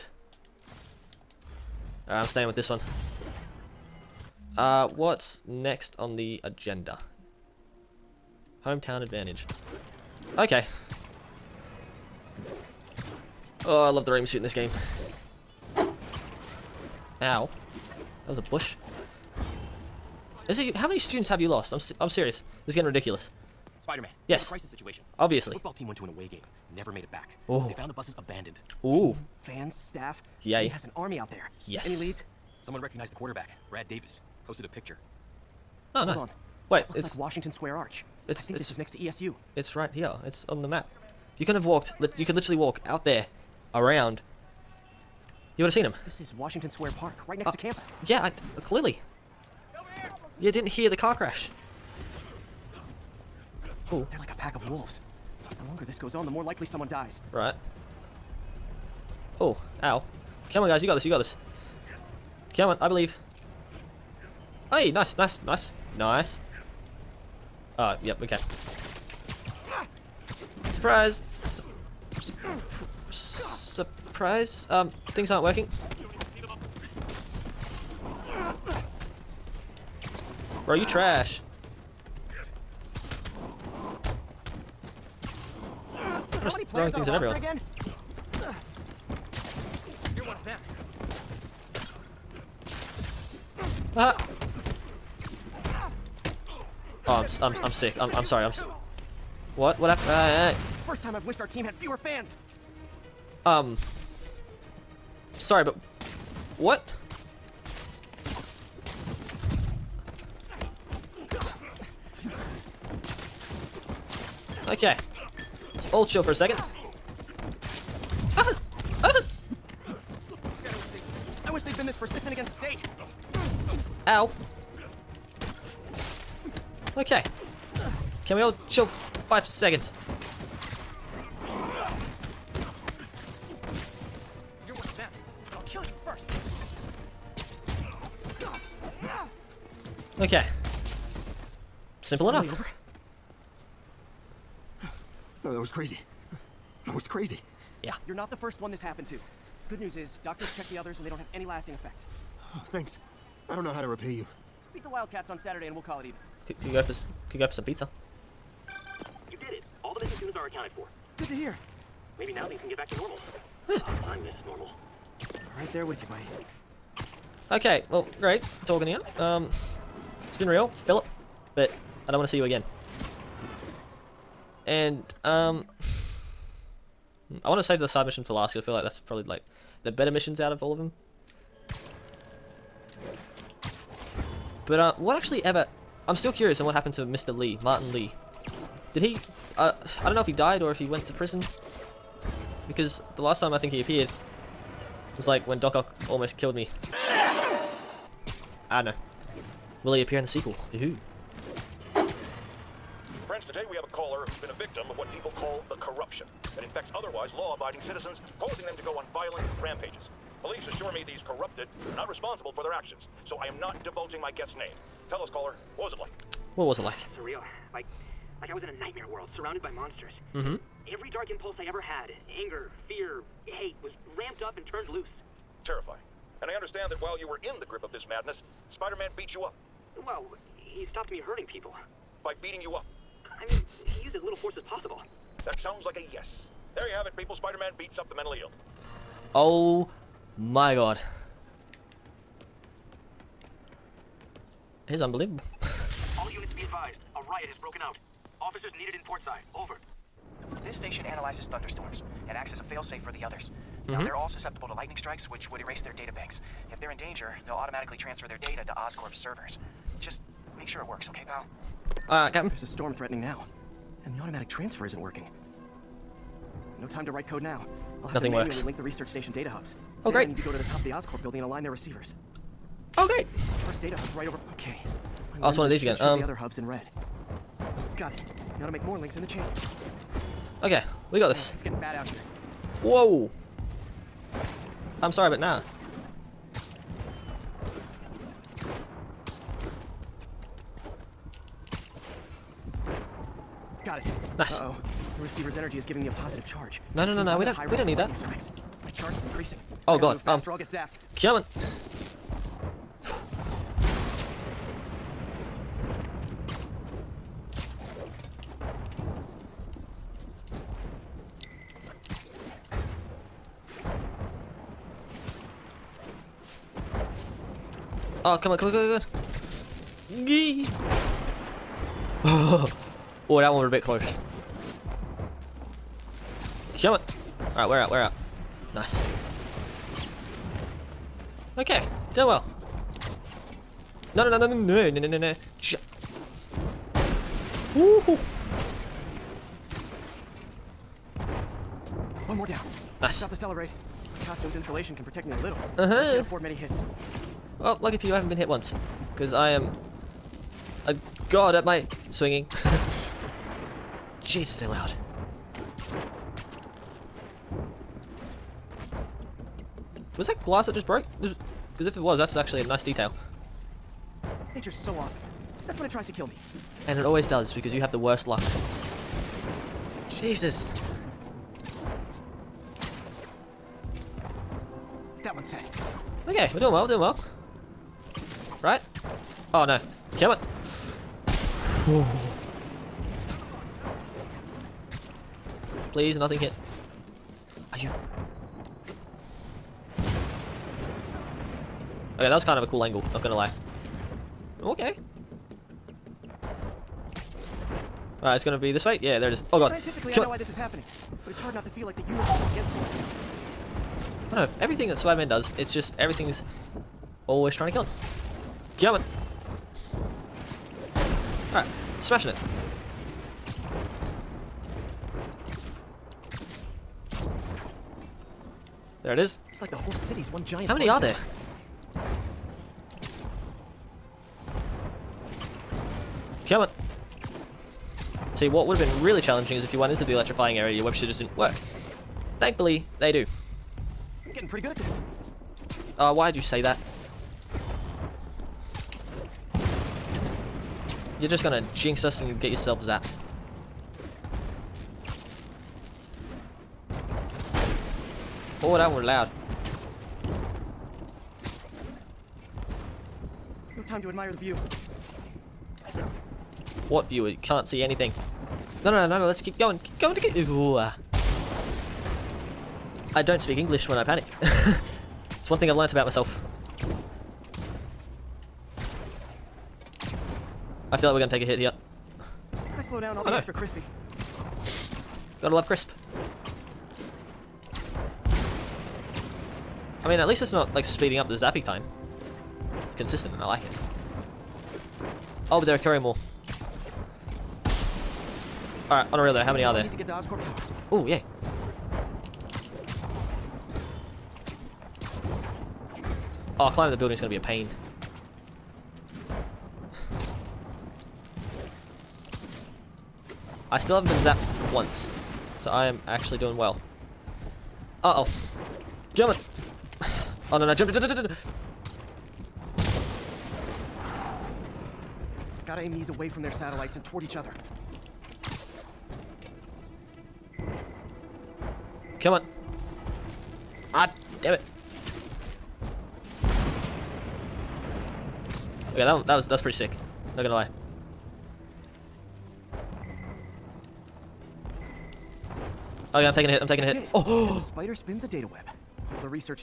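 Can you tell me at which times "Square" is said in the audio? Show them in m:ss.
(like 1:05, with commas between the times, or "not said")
0:37, 0:46.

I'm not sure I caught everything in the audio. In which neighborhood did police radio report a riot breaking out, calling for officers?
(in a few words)
Portside.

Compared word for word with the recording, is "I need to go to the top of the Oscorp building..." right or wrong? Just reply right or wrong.
right.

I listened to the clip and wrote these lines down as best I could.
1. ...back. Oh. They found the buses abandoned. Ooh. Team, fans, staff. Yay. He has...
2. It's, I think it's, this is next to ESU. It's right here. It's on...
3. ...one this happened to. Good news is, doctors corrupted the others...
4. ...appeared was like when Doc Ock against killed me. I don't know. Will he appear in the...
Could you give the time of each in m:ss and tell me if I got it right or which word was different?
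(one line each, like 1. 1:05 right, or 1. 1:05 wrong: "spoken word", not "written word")
1. 0:27 right
2. 0:38 right
3. 2:28 wrong: "checked", not "corrupted"
4. 3:13 wrong: "almost", not "against".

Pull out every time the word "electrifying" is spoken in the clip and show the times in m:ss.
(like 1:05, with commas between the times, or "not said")
7:10.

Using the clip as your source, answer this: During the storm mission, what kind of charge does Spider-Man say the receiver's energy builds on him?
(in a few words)
positive charge.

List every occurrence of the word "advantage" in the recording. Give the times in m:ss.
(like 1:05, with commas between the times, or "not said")
0:09.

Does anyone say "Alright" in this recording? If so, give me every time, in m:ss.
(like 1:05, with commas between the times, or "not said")
5:27, 6:38, 6:51, 8:08.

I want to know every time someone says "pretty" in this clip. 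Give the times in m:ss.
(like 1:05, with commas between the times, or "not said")
7:14, 8:49.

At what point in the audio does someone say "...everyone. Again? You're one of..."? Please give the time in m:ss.
1:27.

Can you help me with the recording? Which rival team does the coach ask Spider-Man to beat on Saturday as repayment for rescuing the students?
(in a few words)
Wildcats.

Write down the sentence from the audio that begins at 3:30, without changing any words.
Police assure me these corrupted are not responsible for their actions, so I am not divulging my guest's name.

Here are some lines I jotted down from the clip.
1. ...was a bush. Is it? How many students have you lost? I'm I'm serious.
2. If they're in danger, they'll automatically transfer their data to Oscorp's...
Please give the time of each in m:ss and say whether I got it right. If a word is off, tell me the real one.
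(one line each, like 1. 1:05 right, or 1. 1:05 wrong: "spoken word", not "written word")
1. 0:18 right
2. 4:16 right.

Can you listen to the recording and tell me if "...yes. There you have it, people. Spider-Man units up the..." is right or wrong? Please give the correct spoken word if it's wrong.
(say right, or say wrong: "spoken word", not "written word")
wrong: "beats", not "units".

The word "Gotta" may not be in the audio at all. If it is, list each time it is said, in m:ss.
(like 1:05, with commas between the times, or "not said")
7:55, 8:35.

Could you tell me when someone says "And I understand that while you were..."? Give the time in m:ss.
3:46.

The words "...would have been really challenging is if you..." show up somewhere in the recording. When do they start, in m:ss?
7:08.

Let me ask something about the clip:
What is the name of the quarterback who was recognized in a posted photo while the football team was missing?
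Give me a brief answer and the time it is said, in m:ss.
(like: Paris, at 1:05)
Brad Davis, at 0:33.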